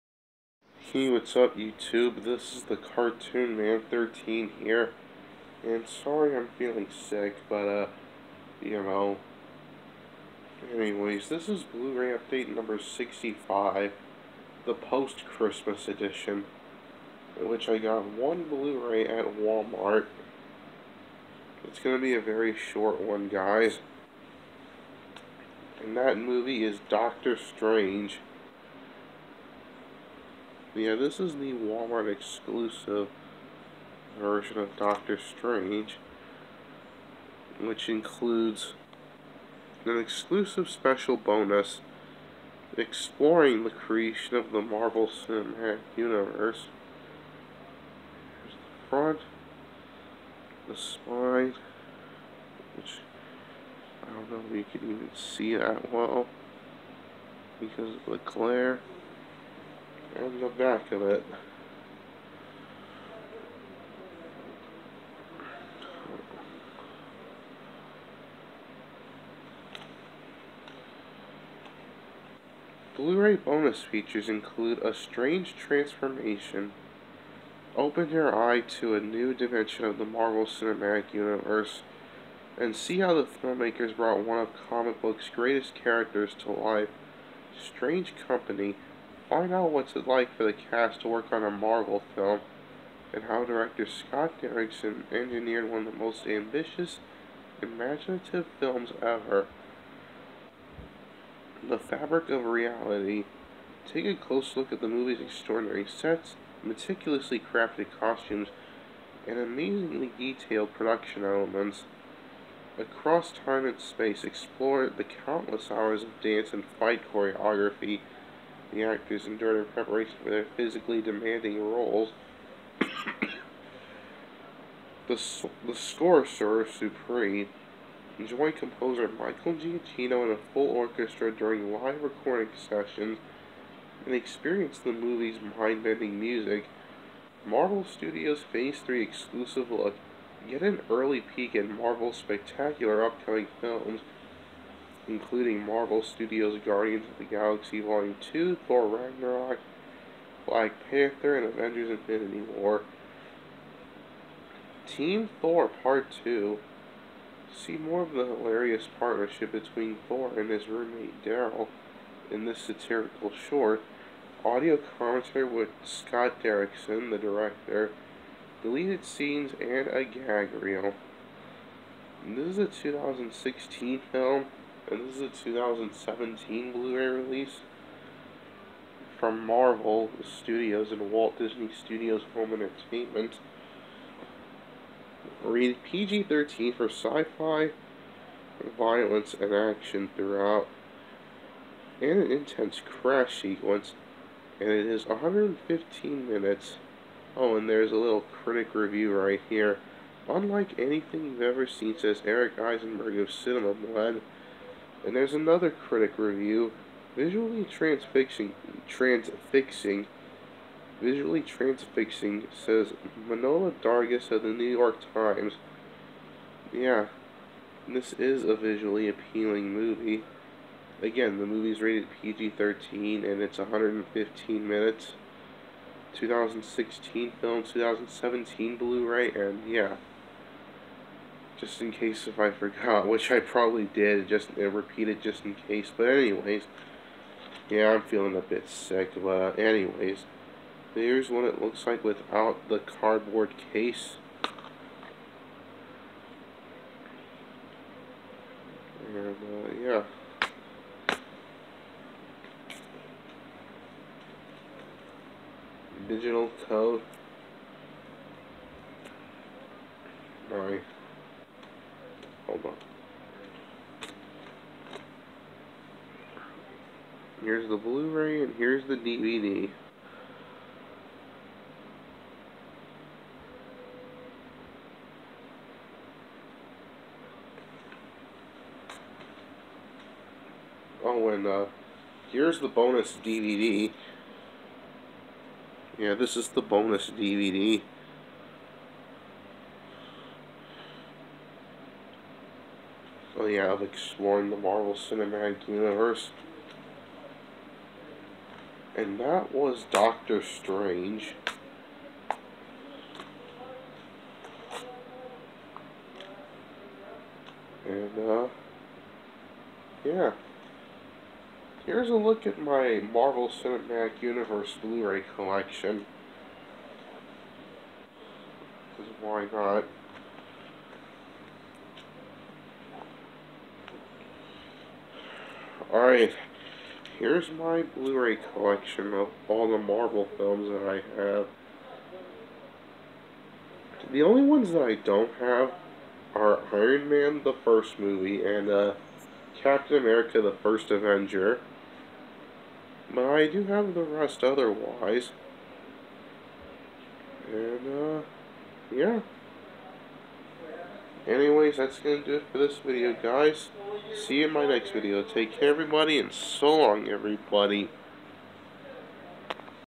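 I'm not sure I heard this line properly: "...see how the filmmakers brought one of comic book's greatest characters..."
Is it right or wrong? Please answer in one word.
right.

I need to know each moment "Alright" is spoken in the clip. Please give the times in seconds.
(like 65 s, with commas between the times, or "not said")
260 s, 325 s.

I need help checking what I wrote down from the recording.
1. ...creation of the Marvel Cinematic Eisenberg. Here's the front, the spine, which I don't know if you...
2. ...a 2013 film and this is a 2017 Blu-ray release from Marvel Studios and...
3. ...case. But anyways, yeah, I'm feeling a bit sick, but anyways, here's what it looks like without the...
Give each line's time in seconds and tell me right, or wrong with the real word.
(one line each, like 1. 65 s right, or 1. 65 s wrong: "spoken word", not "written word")
1. 43 s wrong: "Universe", not "Eisenberg"
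2. 172 s wrong: "2016", not "2013"
3. 235 s right.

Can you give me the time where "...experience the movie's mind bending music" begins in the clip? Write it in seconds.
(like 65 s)
134 s.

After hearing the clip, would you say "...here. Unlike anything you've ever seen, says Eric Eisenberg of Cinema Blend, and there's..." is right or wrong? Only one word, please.
right.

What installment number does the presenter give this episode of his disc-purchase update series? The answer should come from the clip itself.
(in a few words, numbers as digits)
65.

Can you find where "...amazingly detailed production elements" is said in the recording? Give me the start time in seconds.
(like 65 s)
109 s.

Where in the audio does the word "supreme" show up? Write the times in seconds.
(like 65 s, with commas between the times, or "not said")
126 s.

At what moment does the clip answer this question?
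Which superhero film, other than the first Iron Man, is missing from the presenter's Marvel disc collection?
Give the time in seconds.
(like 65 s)
339 s.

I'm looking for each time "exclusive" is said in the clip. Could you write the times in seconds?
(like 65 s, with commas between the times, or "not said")
32 s, 39 s, 139 s.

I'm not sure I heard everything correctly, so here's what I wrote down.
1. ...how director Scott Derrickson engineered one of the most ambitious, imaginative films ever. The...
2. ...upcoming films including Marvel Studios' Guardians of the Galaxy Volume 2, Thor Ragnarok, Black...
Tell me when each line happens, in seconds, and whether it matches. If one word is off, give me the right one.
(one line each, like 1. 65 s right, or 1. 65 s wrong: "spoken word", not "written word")
1. 93 s right
2. 143 s right.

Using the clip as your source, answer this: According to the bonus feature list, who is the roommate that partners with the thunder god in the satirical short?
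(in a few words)
Daryl.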